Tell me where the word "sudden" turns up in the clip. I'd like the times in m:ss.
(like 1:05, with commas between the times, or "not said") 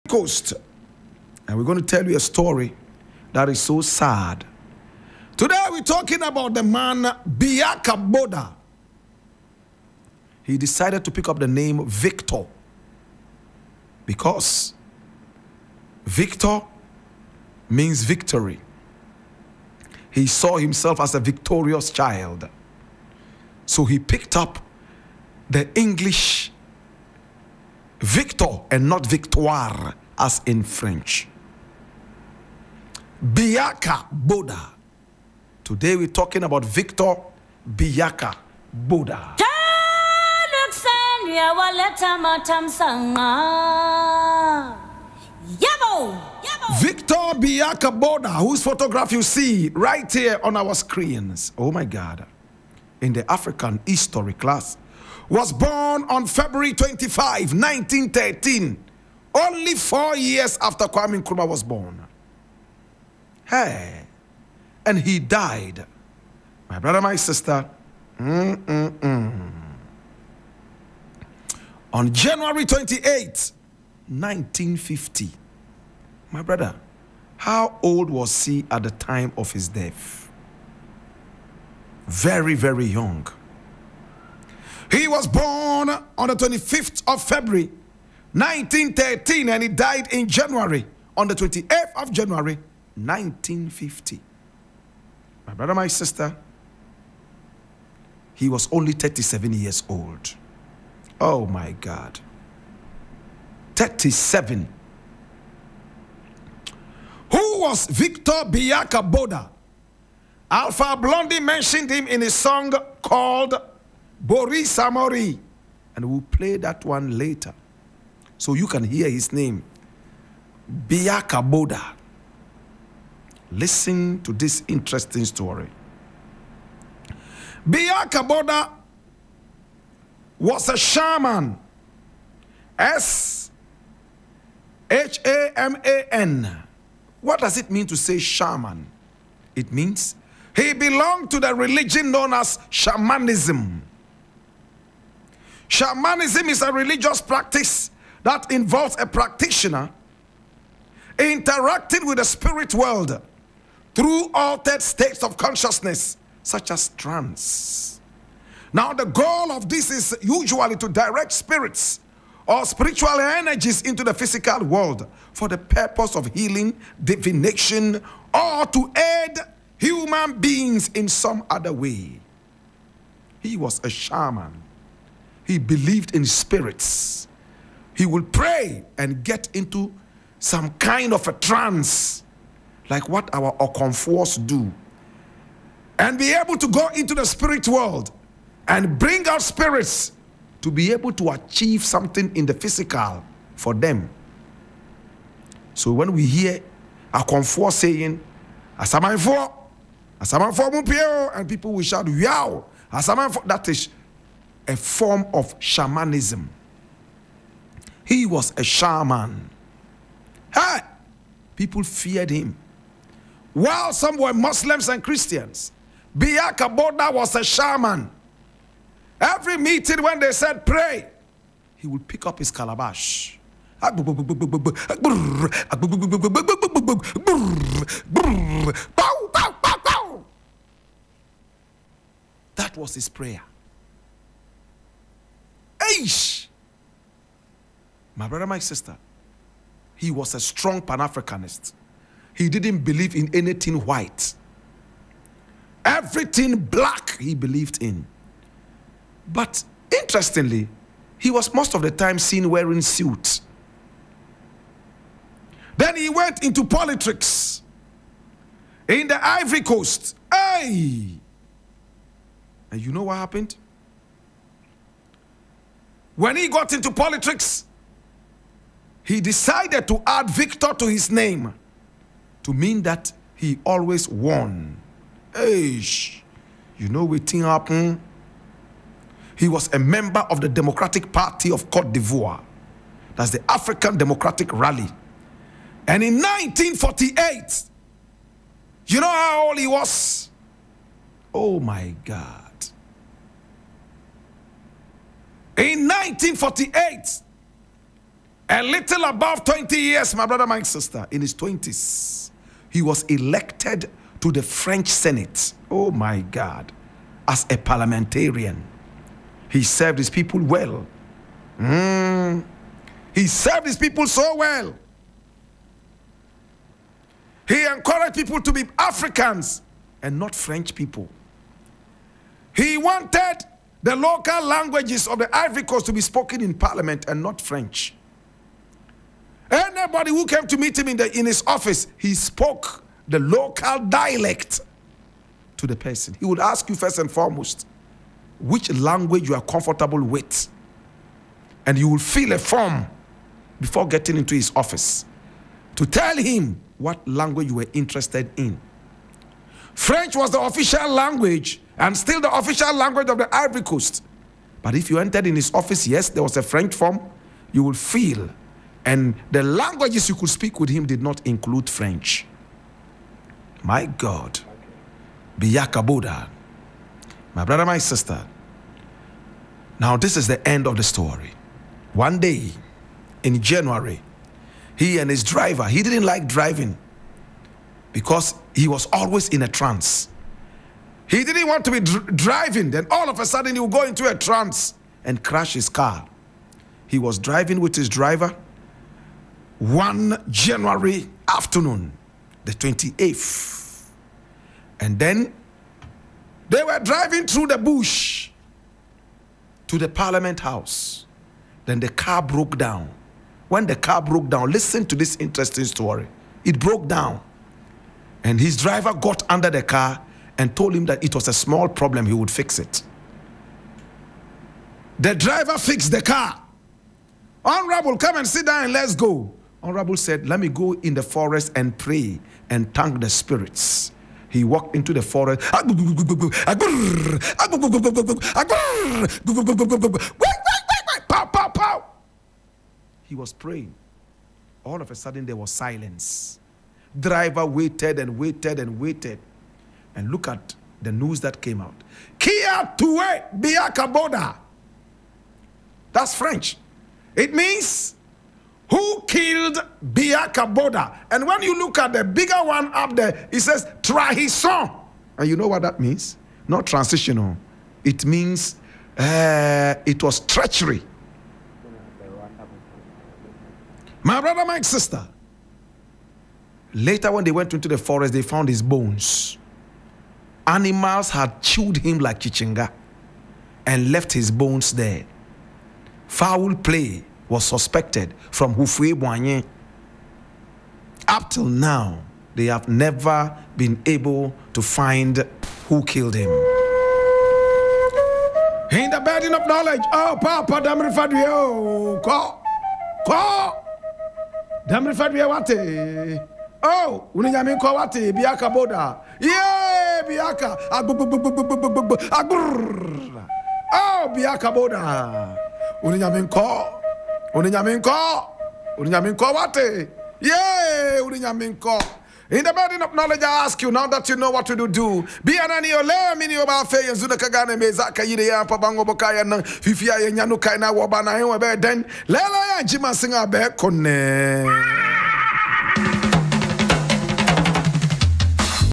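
6:23, 7:14.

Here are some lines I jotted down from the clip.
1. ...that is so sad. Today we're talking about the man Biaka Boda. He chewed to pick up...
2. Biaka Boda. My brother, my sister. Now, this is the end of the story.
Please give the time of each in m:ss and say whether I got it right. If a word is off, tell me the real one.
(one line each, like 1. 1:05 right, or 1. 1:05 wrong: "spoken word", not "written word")
1. 0:03 wrong: "decided", not "chewed"
2. 6:05 right.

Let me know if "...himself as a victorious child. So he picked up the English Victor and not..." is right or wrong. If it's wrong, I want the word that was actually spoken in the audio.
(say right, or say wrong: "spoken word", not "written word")
right.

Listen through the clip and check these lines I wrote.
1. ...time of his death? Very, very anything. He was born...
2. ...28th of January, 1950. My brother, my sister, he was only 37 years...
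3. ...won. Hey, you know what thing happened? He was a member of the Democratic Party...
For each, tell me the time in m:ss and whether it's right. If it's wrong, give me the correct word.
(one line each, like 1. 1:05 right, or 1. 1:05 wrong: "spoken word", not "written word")
1. 1:18 wrong: "young", not "anything"
2. 1:31 right
3. 4:34 right.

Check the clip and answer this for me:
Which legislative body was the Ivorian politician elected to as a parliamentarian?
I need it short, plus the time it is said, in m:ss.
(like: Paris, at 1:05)
French Senate, at 5:04.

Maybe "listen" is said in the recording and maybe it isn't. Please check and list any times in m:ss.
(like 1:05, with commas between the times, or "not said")
2:03, 6:44.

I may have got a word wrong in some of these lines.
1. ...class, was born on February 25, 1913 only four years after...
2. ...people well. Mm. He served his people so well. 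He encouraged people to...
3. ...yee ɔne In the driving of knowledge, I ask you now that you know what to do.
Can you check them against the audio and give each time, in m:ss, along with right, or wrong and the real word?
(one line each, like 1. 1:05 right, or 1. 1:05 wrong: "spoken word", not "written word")
1. 0:54 right
2. 5:10 right
3. 8:30 wrong: "building", not "driving".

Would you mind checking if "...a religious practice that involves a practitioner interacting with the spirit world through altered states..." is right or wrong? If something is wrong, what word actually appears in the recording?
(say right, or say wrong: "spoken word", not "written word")
right.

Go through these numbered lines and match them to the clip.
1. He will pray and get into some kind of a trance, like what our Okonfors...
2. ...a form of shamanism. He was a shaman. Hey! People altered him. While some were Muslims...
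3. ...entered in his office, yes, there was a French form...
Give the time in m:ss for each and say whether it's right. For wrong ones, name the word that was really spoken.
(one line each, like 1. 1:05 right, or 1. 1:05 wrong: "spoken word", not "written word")
1. 2:58 right
2. 3:24 wrong: "feared", not "altered"
3. 5:54 right.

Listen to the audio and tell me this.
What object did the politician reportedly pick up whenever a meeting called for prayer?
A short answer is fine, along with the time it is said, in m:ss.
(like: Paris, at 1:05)
calabash, at 3:42.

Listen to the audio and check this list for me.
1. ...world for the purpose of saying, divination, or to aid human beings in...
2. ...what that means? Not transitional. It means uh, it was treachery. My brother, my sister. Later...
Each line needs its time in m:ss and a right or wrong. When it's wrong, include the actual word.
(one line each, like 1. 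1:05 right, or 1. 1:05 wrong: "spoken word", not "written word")
1. 2:44 wrong: "healing", not "saying"
2. 7:35 right.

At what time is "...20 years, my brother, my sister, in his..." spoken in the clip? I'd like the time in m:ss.
4:59.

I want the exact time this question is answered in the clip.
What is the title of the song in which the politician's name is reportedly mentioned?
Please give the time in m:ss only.
1:54.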